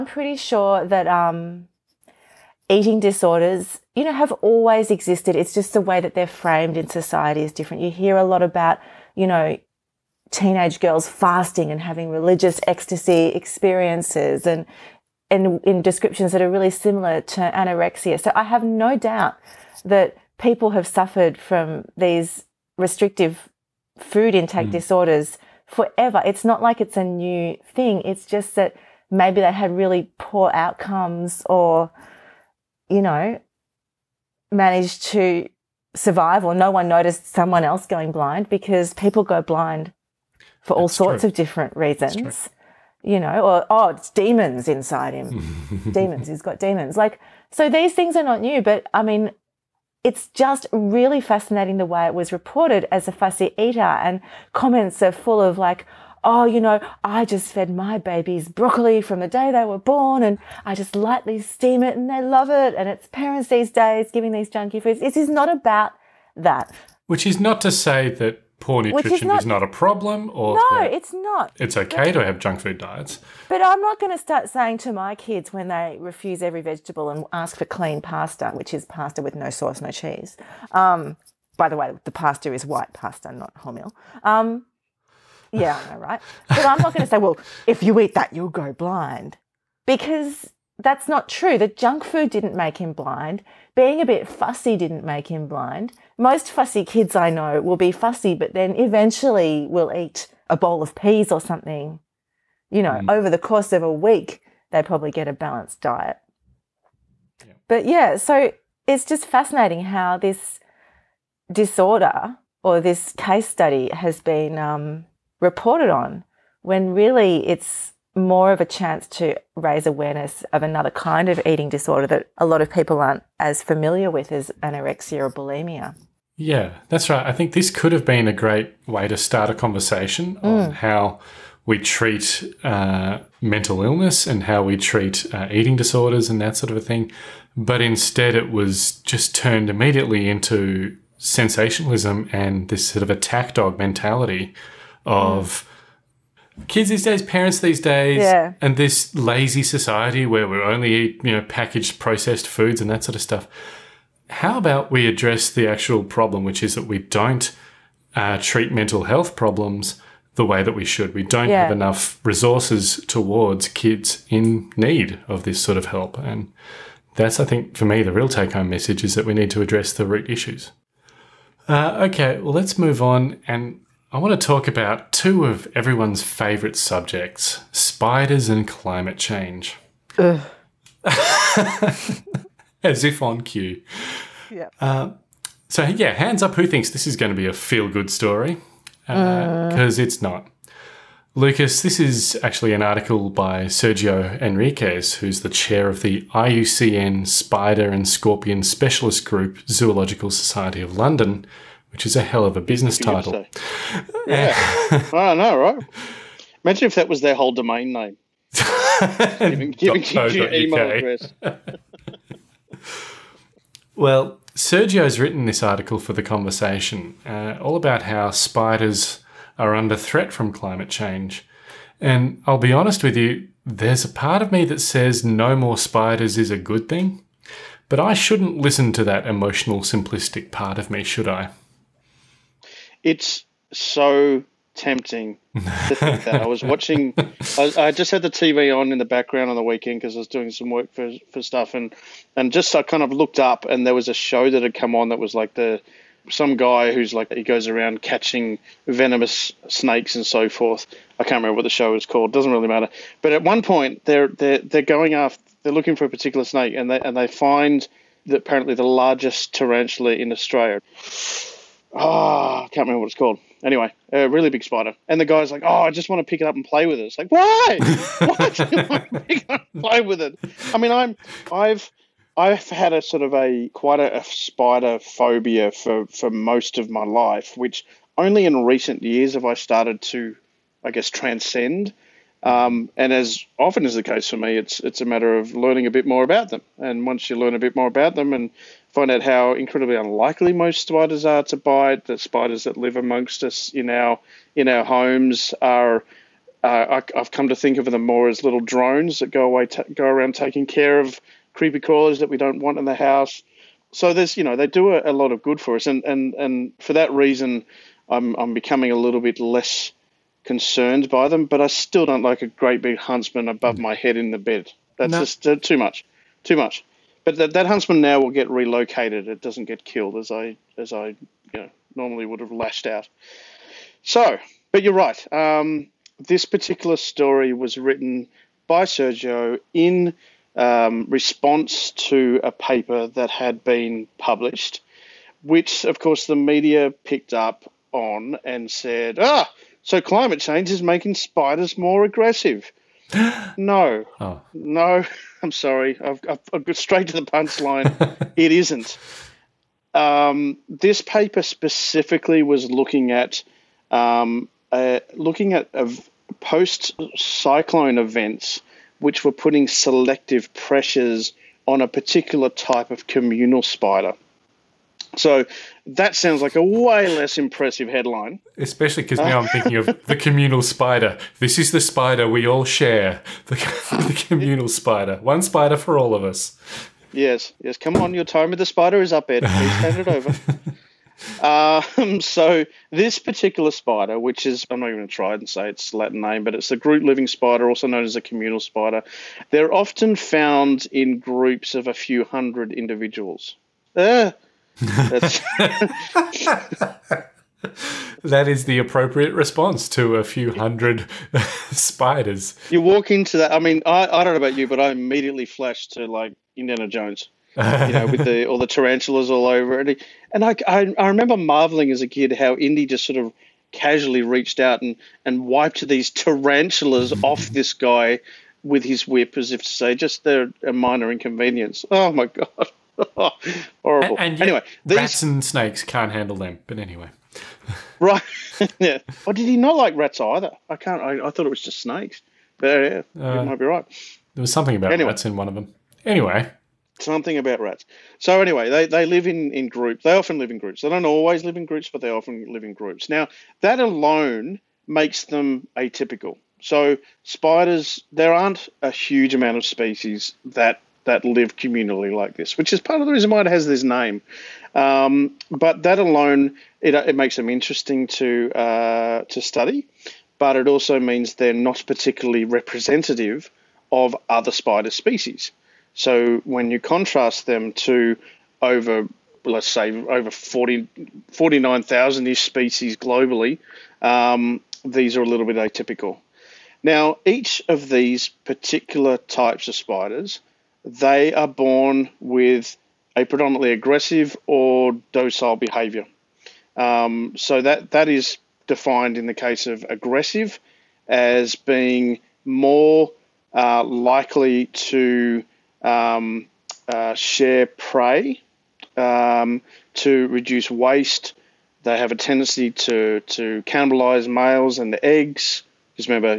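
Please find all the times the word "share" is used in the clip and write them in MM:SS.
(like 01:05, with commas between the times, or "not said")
06:12, 08:17.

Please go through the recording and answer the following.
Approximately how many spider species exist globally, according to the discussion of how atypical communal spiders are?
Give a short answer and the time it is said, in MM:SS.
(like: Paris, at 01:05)
49,000, at 07:50.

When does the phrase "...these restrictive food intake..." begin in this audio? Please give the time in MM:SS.
00:21.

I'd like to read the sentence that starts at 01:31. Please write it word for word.
The junk food didn't make him blind.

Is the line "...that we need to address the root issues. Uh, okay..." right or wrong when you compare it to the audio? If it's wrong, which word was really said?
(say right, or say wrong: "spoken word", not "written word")
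right.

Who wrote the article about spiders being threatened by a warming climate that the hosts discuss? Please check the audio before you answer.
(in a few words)
Sergio Henriques.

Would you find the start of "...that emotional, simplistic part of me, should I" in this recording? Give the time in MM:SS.
03:49.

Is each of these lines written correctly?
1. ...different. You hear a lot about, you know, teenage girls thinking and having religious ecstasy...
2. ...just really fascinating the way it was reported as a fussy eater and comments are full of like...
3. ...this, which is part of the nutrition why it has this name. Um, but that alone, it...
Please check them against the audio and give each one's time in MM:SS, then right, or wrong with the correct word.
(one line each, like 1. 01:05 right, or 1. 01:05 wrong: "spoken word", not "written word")
1. 00:07 wrong: "fasting", not "thinking"
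2. 00:50 right
3. 07:32 wrong: "reason", not "nutrition".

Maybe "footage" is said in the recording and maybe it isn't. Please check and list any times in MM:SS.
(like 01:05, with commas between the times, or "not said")
not said.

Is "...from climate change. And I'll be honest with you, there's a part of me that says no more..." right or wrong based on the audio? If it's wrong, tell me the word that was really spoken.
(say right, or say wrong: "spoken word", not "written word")
right.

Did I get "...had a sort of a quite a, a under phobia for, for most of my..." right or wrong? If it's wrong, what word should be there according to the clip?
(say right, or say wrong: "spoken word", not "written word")
wrong: "spider", not "under".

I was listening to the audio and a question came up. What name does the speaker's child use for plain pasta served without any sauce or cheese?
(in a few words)
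clean pasta.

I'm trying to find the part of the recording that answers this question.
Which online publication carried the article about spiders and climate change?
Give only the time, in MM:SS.
03:36.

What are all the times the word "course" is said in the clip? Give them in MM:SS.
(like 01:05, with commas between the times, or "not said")
01:43, 05:35.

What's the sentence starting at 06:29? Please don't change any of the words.
They're often found in groups of a few hundred individuals.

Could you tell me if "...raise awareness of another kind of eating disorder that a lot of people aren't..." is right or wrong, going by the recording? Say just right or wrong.
right.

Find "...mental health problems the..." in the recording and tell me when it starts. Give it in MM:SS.
02:38.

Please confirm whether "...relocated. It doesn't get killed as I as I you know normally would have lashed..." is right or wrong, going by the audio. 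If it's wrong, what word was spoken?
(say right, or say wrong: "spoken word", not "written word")
right.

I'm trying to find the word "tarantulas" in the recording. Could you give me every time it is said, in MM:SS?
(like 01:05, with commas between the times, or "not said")
04:19, 06:48, 06:56.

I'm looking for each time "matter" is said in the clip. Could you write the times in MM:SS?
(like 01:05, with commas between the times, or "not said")
04:12, 04:45.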